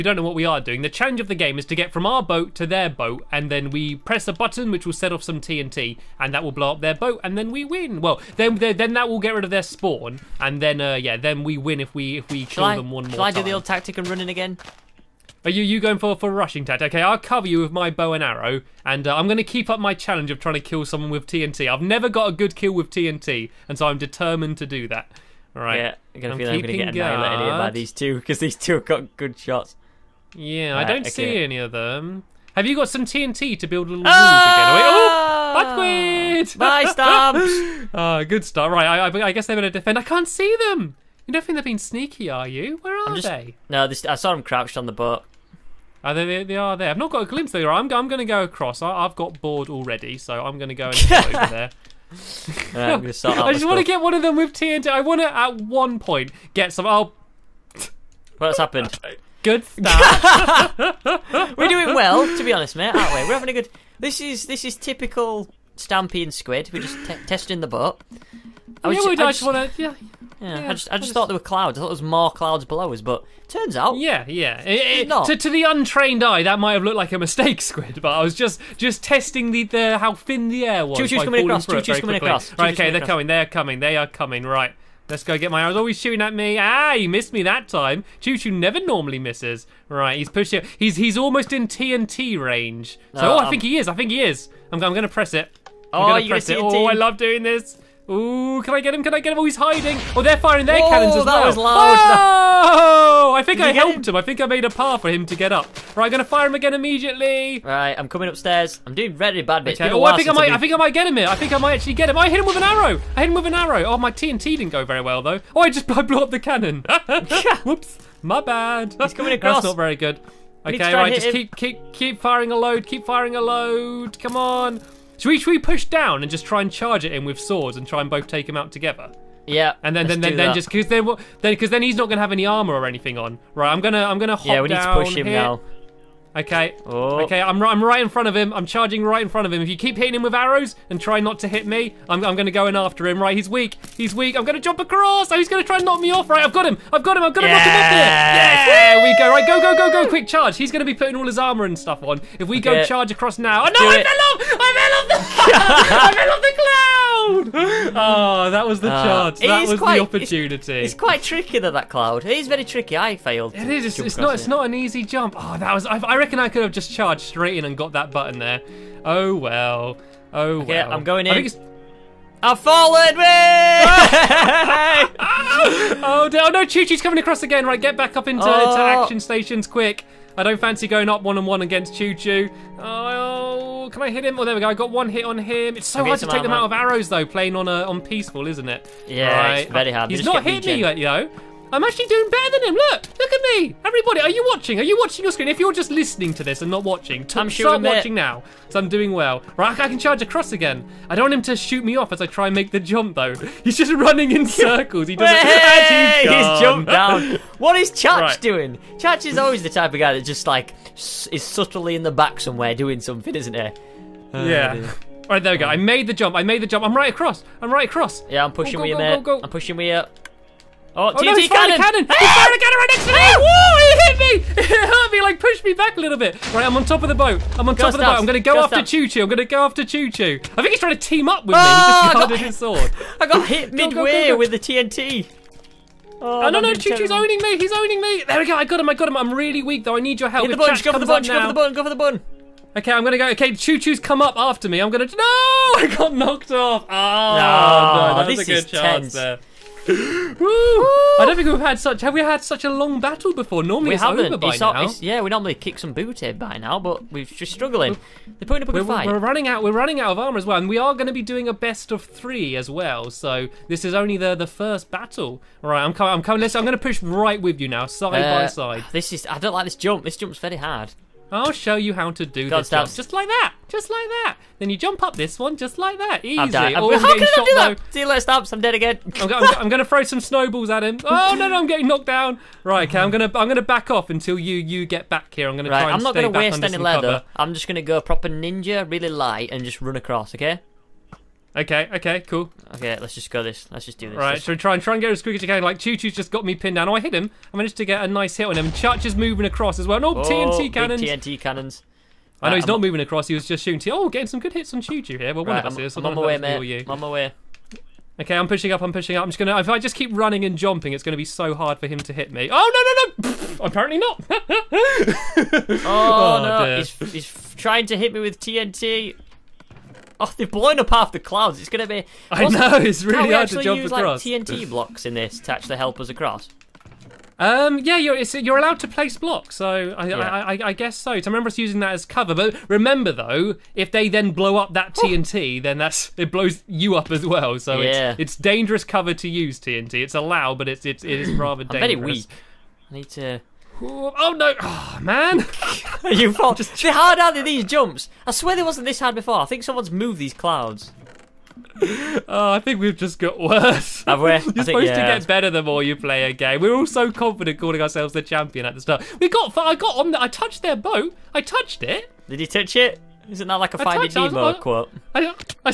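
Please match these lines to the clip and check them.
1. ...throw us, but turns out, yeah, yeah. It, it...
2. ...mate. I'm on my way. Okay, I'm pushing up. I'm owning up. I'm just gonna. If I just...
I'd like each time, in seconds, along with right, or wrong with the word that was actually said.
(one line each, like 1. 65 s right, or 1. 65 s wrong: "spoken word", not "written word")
1. 72 s wrong: "below", not "throw"
2. 306 s wrong: "pushing", not "owning".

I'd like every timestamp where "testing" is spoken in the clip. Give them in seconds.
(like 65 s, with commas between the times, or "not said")
67 s, 79 s.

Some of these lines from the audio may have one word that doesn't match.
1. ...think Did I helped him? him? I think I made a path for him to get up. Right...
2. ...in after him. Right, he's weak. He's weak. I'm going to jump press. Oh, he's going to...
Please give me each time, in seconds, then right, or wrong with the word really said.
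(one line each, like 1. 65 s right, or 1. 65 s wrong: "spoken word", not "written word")
1. 103 s right
2. 142 s wrong: "across", not "press".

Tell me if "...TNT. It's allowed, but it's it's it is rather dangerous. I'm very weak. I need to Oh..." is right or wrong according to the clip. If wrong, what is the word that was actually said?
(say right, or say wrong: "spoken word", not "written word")
right.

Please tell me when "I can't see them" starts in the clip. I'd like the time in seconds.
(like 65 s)
39 s.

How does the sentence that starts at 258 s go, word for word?
They're putting up a good we're, fight.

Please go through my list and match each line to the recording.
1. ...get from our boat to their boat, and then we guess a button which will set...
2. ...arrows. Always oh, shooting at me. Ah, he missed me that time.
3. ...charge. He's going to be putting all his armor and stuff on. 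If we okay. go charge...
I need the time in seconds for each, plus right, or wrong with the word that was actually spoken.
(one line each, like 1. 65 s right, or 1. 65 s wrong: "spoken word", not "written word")
1. 1 s wrong: "press", not "guess"
2. 85 s right
3. 150 s right.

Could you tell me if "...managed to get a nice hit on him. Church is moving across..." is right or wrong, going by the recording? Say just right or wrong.
right.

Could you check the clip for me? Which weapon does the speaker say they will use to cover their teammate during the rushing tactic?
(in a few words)
Bow and arrow.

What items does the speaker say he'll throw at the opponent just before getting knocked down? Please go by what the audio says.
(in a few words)
Snowballs.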